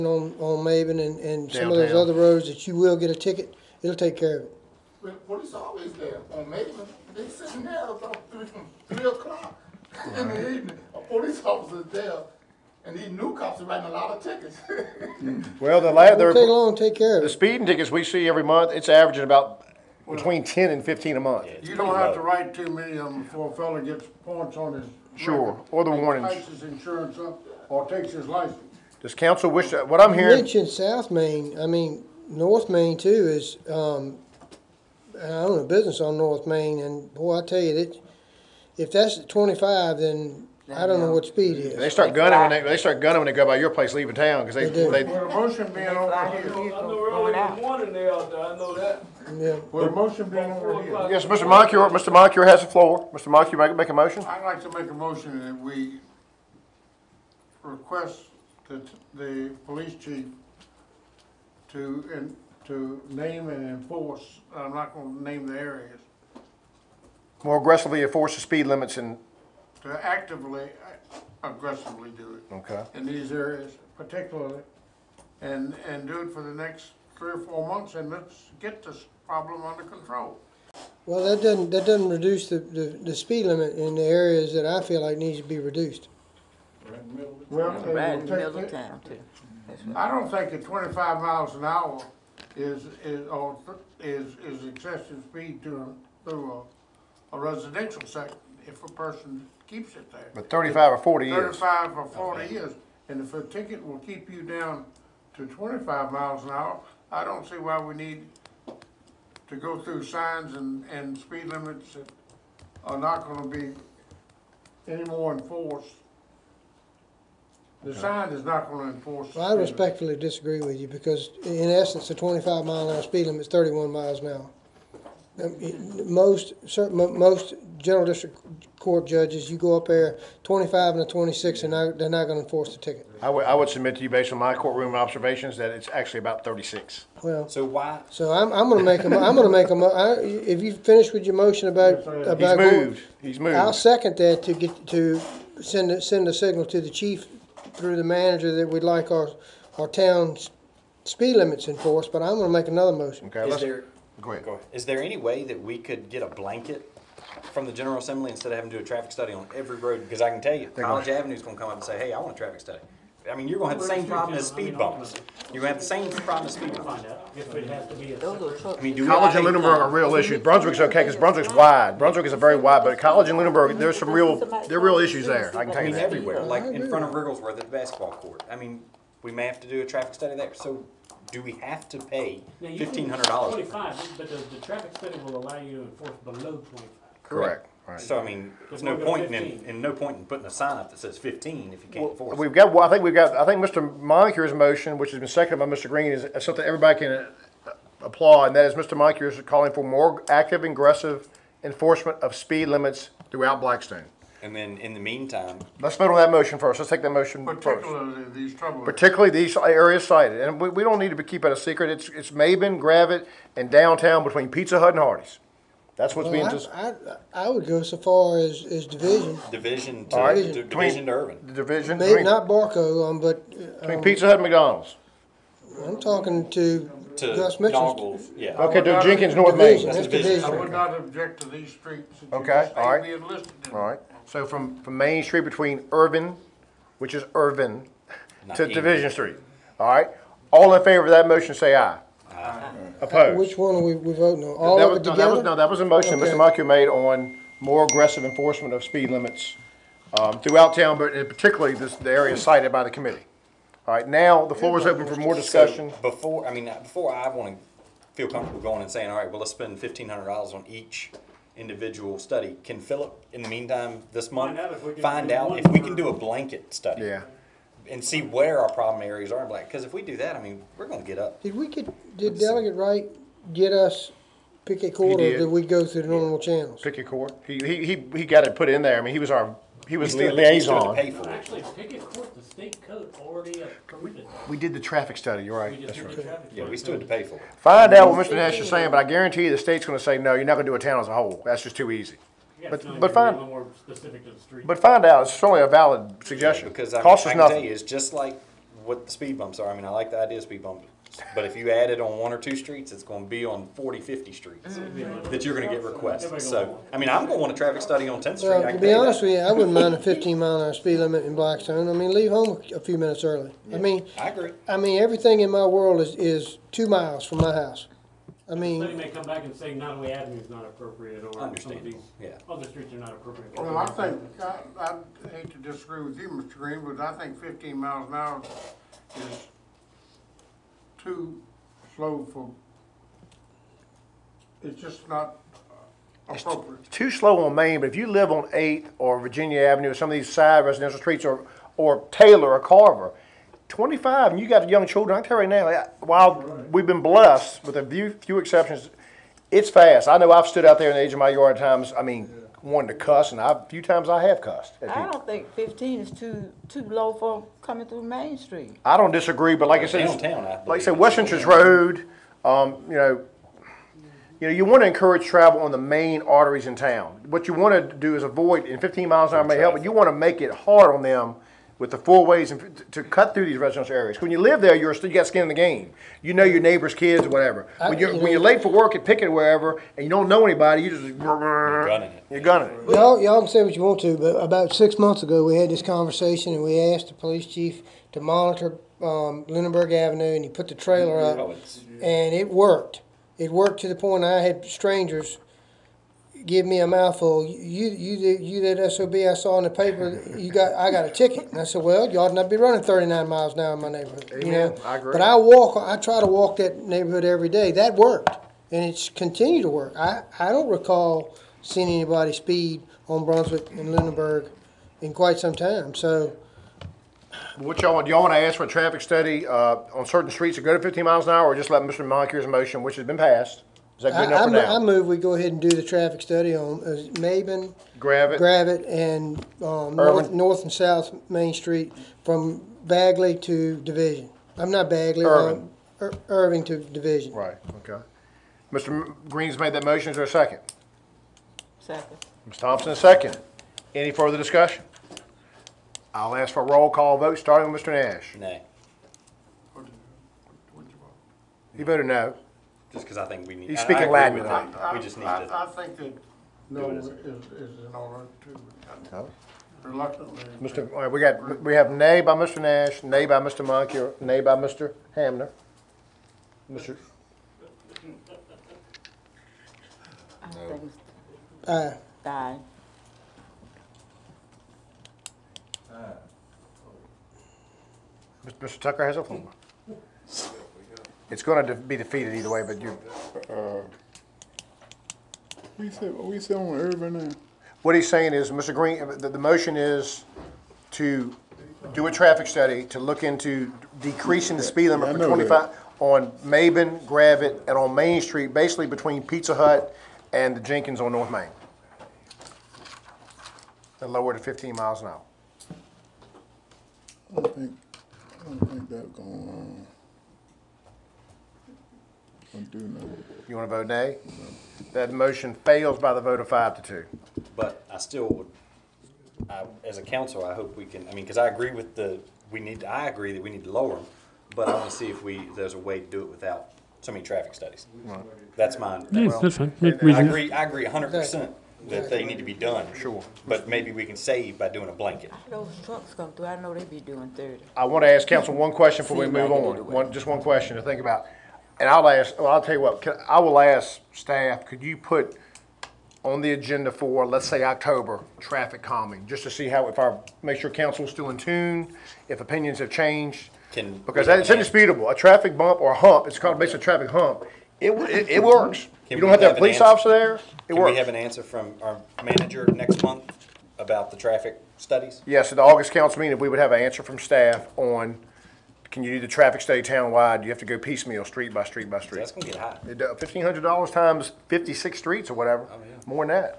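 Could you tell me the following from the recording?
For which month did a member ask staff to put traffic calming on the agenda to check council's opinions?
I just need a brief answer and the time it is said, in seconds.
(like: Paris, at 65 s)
October, at 547 s.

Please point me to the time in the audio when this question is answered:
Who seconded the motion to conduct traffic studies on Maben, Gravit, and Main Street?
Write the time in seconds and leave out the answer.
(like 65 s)
442 s.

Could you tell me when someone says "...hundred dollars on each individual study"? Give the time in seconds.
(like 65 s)
260 s.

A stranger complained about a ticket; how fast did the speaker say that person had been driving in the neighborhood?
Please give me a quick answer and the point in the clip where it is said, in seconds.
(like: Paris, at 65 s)
39 mph, at 402 s.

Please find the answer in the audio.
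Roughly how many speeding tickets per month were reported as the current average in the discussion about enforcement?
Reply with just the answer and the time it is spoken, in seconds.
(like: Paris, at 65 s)
10 to 15, at 20 s.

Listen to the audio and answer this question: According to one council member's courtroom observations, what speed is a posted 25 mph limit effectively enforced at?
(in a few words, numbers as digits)
36.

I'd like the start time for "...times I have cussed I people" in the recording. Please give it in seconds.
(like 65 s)
353 s.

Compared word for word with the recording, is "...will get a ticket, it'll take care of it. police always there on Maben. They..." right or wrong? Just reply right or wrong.
right.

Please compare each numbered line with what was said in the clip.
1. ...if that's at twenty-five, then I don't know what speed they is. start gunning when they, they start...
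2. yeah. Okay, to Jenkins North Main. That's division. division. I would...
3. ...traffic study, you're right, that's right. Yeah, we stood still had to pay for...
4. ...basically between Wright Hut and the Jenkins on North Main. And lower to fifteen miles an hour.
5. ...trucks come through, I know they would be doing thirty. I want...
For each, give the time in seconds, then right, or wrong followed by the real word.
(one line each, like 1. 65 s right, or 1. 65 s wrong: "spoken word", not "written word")
1. 38 s right
2. 228 s right
3. 284 s right
4. 498 s wrong: "Pizza", not "Wright"
5. 535 s right.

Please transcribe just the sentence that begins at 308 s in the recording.
Well, I to can be honest that.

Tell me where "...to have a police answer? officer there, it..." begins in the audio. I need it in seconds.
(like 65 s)
559 s.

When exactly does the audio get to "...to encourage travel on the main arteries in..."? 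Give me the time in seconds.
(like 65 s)
364 s.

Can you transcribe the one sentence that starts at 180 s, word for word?
So do we have to pay fifteen hundred dollars?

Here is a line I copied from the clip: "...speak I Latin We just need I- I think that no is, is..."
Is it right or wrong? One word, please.
right.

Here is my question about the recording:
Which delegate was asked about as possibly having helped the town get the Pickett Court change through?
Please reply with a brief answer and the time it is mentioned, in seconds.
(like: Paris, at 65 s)
Delegate Wright, at 272 s.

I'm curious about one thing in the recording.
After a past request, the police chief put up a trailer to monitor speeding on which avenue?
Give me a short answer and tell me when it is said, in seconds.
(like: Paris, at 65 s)
Lunenburg Avenue, at 389 s.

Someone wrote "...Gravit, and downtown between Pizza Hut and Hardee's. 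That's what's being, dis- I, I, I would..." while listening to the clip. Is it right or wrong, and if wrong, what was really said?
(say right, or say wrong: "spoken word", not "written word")
right.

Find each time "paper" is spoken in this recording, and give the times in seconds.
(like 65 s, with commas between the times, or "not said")
399 s.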